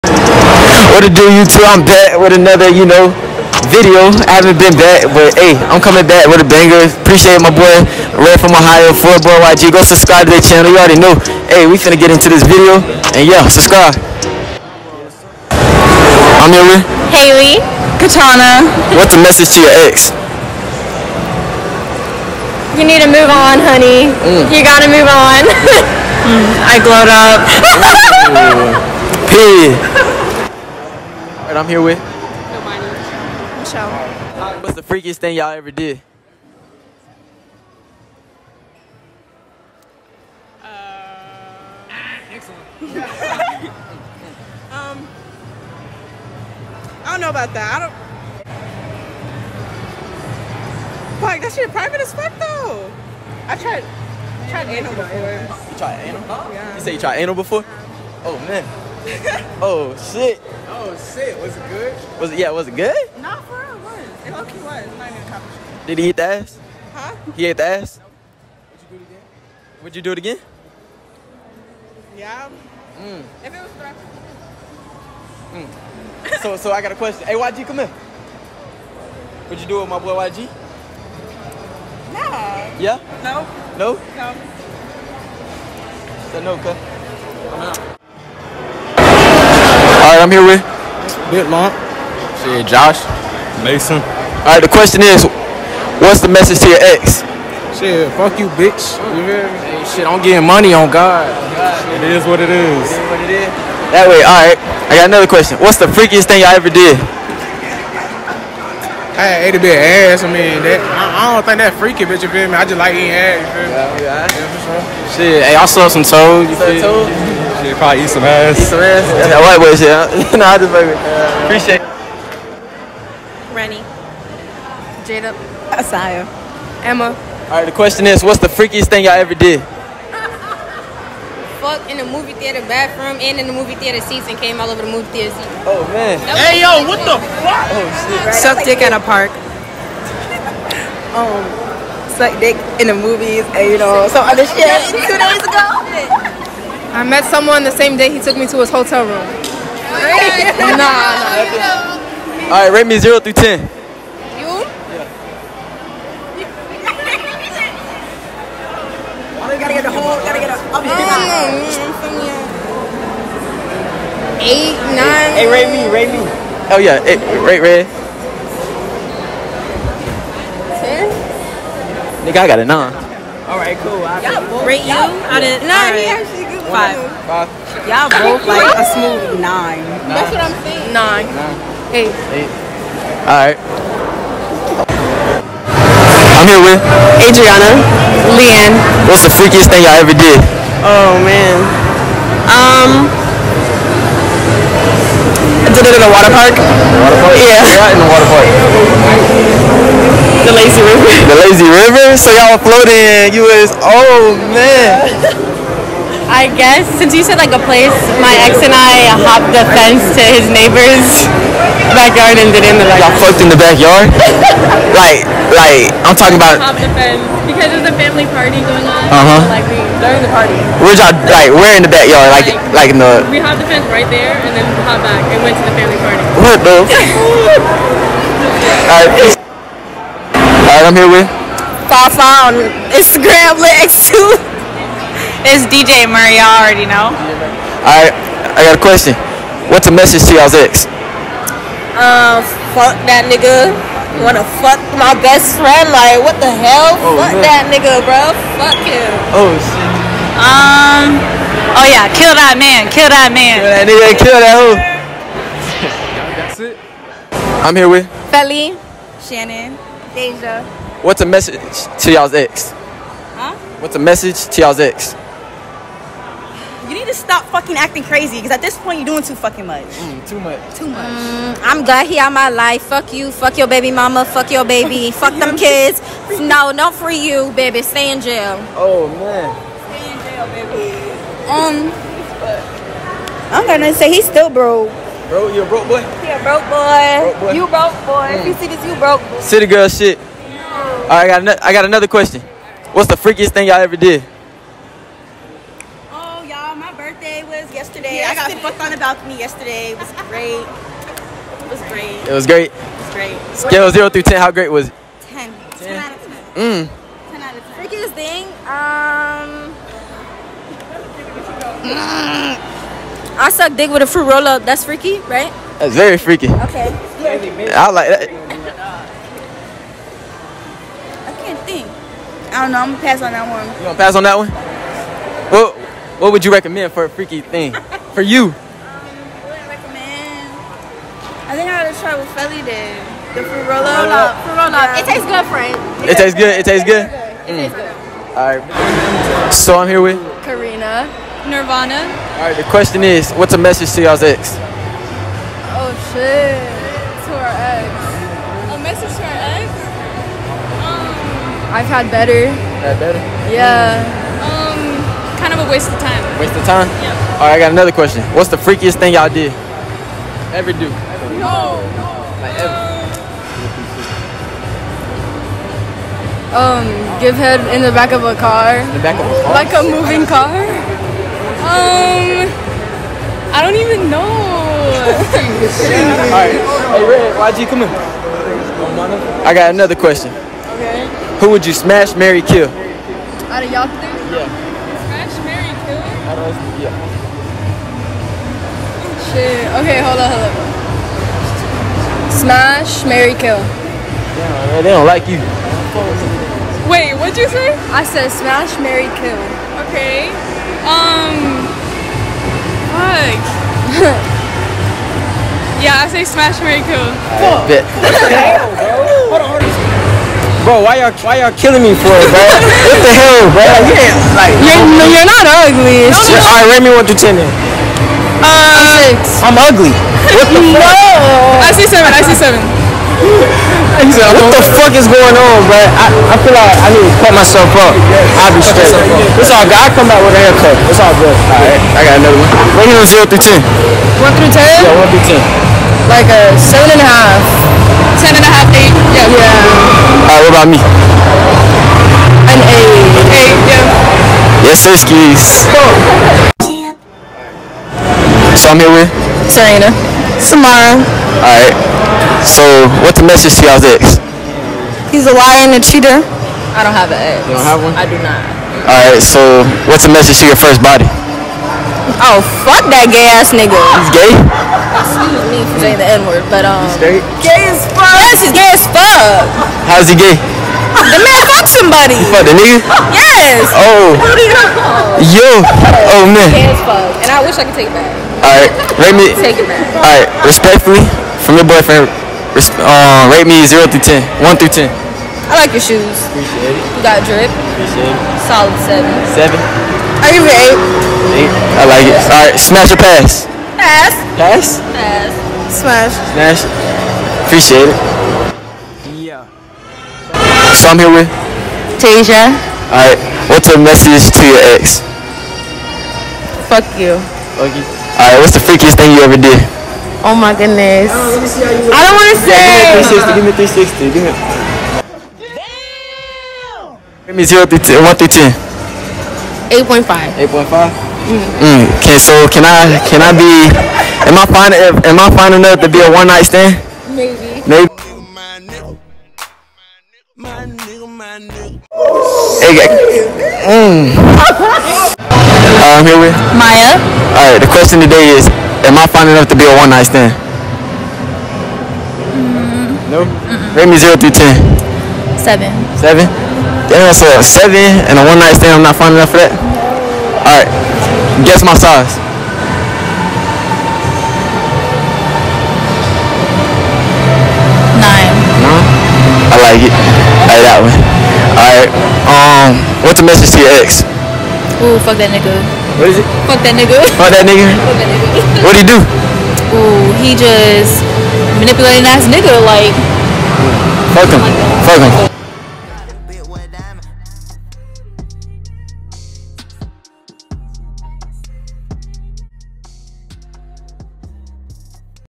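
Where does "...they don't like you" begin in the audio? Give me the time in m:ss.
6:34.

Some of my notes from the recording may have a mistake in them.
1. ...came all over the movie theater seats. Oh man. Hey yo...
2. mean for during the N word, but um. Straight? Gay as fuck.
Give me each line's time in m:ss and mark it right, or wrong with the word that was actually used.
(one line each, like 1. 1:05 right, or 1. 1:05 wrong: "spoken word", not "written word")
1. 2:14 right
2. 7:45 wrong: "saying", not "during".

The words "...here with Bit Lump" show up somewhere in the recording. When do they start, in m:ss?
1:30.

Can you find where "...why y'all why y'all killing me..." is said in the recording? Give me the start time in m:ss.
6:50.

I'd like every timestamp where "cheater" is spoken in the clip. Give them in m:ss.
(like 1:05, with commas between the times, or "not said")
7:35.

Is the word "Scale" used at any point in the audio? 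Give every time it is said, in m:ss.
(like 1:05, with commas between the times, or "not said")
5:03.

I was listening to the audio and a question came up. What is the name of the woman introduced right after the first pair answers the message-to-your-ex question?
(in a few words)
Michelle.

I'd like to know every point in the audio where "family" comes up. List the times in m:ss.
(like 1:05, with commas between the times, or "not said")
3:37, 3:45.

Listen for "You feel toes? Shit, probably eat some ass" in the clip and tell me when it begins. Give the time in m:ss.
1:56.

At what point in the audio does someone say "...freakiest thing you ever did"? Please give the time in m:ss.
8:28.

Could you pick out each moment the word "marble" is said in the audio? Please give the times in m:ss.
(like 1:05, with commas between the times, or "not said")
not said.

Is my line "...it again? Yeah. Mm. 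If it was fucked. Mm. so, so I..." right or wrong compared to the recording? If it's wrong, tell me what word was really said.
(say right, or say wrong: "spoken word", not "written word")
wrong: "threatened", not "fucked".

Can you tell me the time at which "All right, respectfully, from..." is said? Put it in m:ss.
8:00.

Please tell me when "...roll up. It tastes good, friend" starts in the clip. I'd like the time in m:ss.
5:33.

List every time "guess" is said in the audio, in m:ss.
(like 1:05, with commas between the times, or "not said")
3:26, 9:11.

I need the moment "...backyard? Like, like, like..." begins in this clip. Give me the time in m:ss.
3:41.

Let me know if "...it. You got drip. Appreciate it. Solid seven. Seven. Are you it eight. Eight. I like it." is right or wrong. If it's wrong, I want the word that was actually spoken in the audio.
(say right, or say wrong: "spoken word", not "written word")
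right.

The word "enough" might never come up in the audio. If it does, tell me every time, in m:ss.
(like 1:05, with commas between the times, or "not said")
8:45, 8:59, 9:09.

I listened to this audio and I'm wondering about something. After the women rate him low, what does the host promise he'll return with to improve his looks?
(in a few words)
A haircut.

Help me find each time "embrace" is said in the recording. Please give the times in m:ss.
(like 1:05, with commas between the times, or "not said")
not said.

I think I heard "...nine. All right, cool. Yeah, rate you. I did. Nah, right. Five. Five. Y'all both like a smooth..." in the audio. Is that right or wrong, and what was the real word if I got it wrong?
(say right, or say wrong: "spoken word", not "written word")
right.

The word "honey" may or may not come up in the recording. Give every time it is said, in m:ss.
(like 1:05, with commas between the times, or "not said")
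0:23.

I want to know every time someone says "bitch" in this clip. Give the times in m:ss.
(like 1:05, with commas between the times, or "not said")
1:38, 1:52.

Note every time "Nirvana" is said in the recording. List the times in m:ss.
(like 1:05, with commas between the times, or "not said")
5:41.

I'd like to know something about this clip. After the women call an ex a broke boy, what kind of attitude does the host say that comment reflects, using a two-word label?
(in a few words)
City girl.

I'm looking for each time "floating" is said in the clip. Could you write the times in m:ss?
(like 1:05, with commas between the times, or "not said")
3:22.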